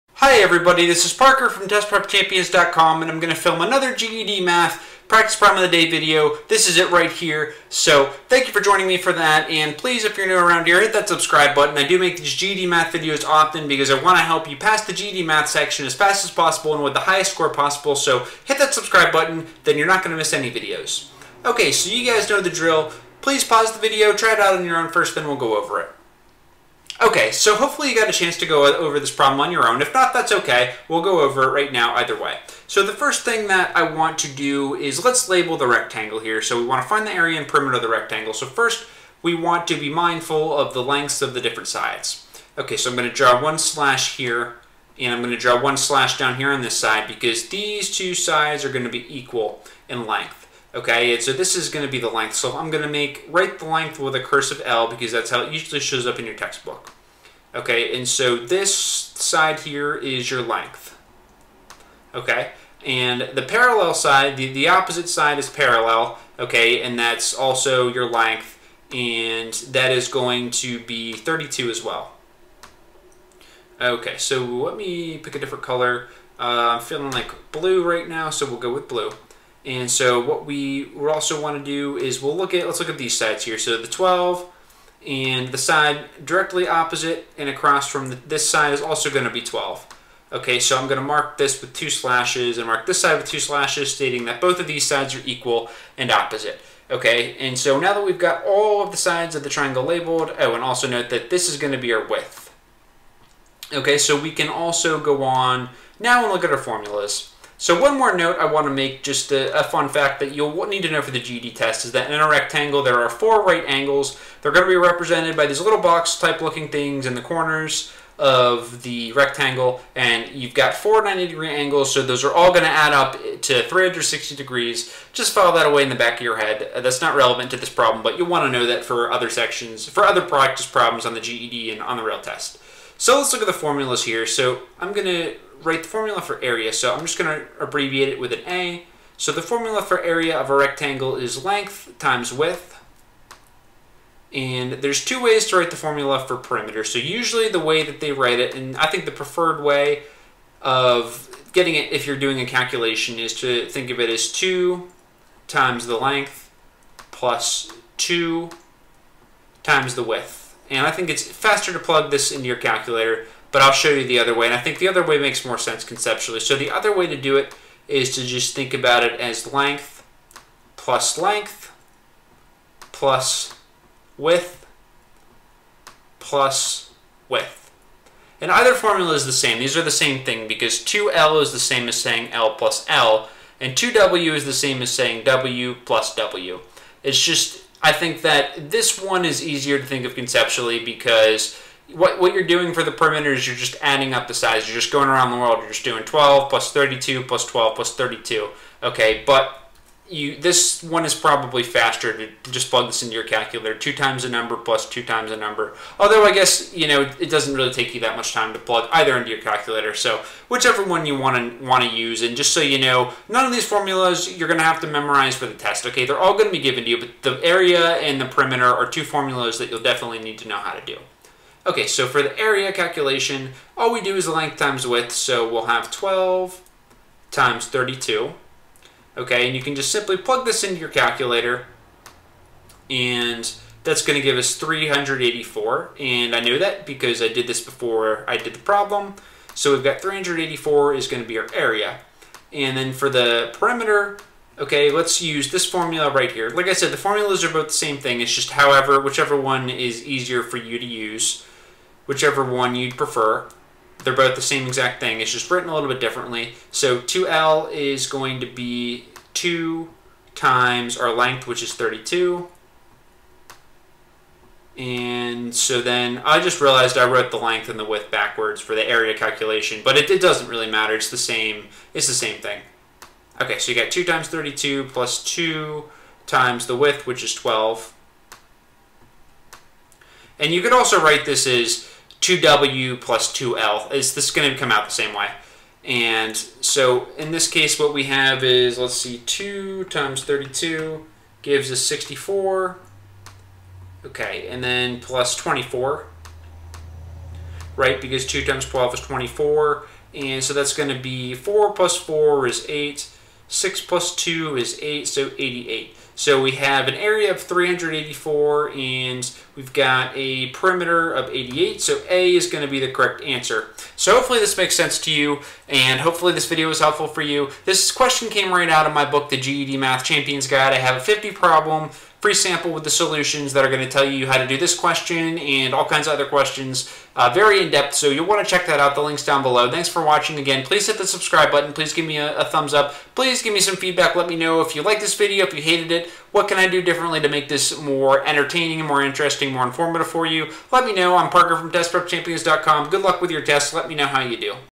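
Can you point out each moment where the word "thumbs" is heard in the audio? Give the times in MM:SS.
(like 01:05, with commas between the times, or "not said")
05:32.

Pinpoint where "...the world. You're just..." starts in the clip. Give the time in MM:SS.
03:15.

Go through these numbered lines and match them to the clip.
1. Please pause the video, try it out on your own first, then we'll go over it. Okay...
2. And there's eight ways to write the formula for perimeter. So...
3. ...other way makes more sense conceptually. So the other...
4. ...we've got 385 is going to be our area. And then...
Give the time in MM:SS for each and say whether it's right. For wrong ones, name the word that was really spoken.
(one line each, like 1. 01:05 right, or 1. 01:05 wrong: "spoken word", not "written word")
1. 00:23 right
2. 02:24 wrong: "two", not "eight"
3. 02:44 right
4. 03:59 wrong: "384", not "385".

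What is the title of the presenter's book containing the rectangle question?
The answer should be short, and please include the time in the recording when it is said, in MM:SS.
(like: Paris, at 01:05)
The GED Math Champions Guide, at 05:19.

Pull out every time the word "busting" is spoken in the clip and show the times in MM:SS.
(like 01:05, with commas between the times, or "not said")
not said.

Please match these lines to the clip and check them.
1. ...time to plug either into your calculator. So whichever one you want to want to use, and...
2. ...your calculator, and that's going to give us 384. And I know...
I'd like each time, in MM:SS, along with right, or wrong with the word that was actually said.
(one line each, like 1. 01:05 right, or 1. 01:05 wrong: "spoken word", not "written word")
1. 03:28 right
2. 03:50 right.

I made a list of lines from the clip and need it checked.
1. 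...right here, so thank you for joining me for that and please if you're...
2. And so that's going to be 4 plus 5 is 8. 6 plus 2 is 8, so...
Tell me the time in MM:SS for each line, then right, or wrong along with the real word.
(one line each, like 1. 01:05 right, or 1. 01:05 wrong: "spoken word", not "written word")
1. 00:06 right
2. 05:00 wrong: "4", not "5".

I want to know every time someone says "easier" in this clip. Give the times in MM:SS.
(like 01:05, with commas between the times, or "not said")
03:09, 04:10.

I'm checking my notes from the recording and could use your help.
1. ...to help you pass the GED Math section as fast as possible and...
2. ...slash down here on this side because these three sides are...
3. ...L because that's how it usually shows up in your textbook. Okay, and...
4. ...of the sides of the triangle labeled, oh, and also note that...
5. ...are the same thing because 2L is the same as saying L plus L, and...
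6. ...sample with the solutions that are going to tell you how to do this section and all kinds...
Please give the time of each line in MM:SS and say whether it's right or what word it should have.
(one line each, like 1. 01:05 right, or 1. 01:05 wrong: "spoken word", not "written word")
1. 00:14 right
2. 00:45 wrong: "two", not "three"
3. 00:54 right
4. 01:38 right
5. 02:59 right
6. 05:22 wrong: "question", not "section".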